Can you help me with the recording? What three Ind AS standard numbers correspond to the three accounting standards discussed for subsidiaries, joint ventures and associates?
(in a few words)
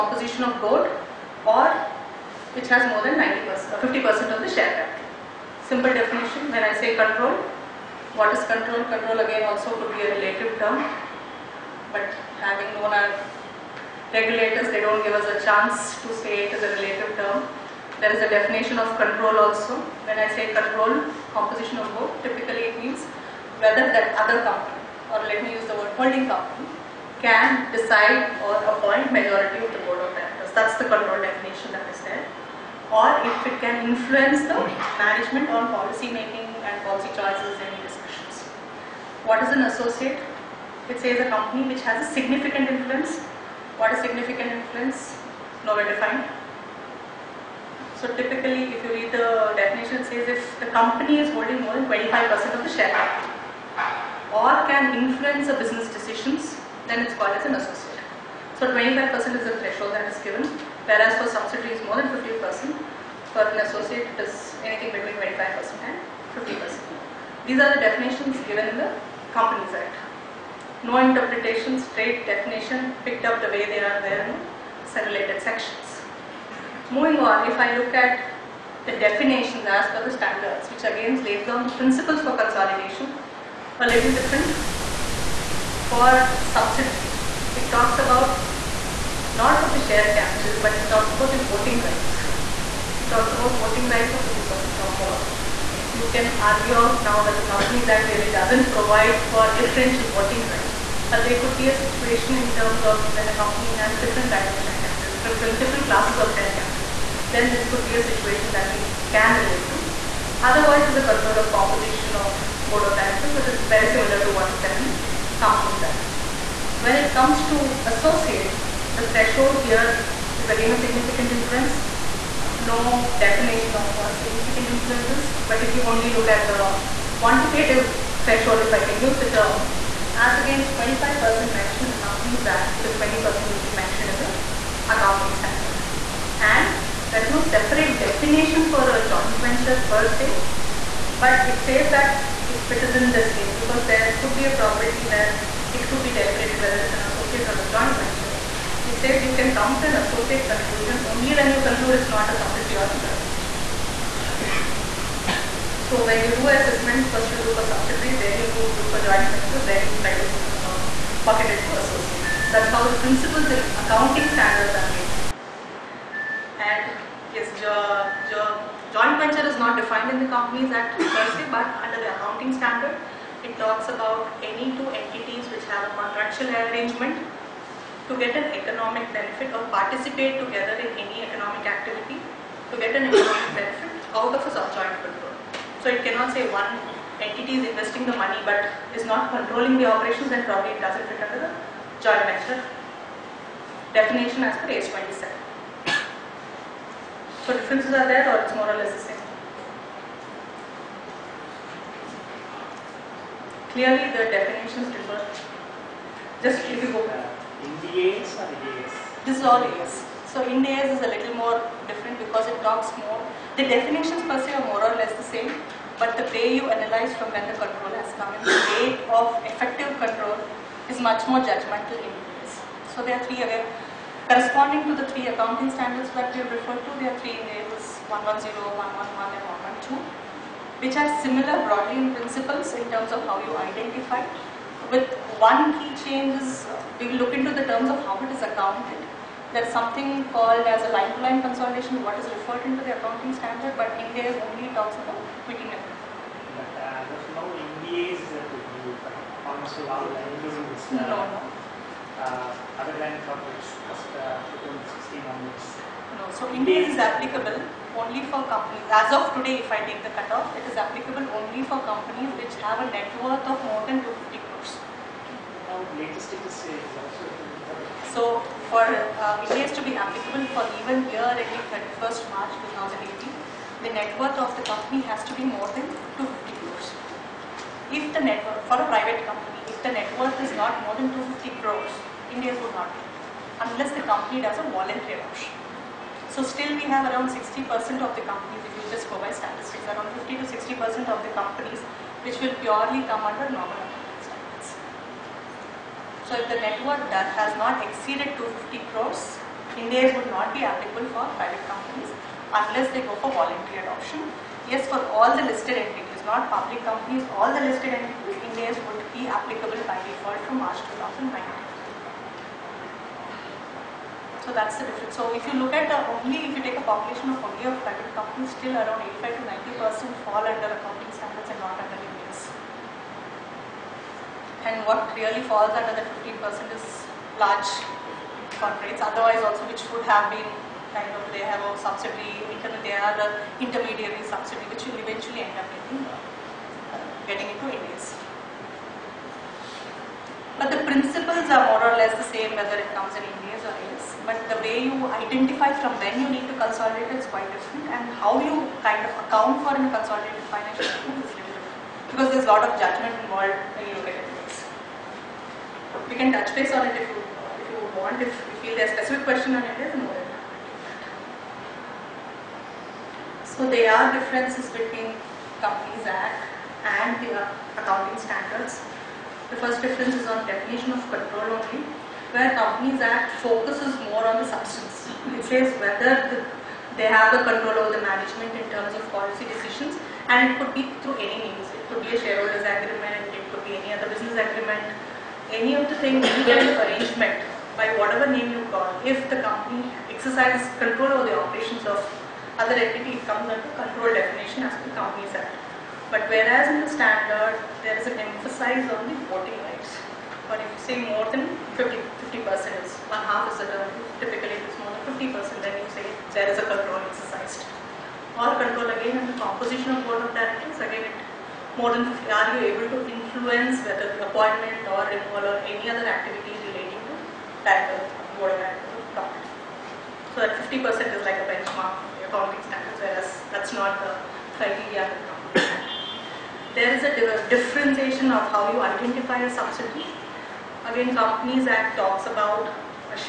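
110, 111 and 112.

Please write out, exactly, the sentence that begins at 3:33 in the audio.
The definitions per se are more or less the same.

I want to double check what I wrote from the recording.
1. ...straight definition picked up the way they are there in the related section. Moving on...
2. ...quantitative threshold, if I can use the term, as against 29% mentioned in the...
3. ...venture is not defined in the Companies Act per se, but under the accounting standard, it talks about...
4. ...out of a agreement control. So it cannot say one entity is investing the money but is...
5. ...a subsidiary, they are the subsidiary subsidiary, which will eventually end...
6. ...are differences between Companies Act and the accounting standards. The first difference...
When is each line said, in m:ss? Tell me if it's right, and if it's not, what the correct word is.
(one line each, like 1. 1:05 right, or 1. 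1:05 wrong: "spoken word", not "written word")
1. 1:11 right
2. 2:07 wrong: "25", not "29"
3. 2:49 right
4. 3:04 wrong: "joint", not "agreement"
5. 5:31 wrong: "intermediary", not "subsidiary"
6. 6:03 right.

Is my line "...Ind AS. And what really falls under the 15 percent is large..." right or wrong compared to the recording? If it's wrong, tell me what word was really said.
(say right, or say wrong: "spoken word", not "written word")
right.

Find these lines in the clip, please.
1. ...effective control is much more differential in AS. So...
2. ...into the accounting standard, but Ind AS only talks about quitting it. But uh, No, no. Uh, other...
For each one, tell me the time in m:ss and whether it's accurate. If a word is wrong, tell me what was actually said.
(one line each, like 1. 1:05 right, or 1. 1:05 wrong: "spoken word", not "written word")
1. 3:39 wrong: "judgmental", not "differential"
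2. 4:02 right.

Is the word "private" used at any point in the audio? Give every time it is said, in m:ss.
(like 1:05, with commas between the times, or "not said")
4:38, 5:01, 5:17.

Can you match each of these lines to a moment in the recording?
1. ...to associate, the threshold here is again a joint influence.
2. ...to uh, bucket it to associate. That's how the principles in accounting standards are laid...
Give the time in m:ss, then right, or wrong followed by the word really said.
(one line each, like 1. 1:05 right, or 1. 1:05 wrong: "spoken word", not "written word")
1. 1:57 wrong: "significant", not "joint"
2. 2:40 right.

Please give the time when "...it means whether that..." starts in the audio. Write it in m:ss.
0:22.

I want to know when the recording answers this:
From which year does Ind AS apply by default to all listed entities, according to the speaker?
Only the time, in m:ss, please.
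5:10.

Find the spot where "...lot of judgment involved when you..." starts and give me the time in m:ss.
5:52.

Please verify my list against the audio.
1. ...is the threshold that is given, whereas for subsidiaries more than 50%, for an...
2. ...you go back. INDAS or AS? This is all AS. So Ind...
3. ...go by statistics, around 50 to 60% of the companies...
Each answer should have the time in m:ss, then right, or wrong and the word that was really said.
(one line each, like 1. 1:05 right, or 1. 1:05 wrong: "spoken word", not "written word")
1. 0:59 right
2. 3:26 right
3. 4:49 right.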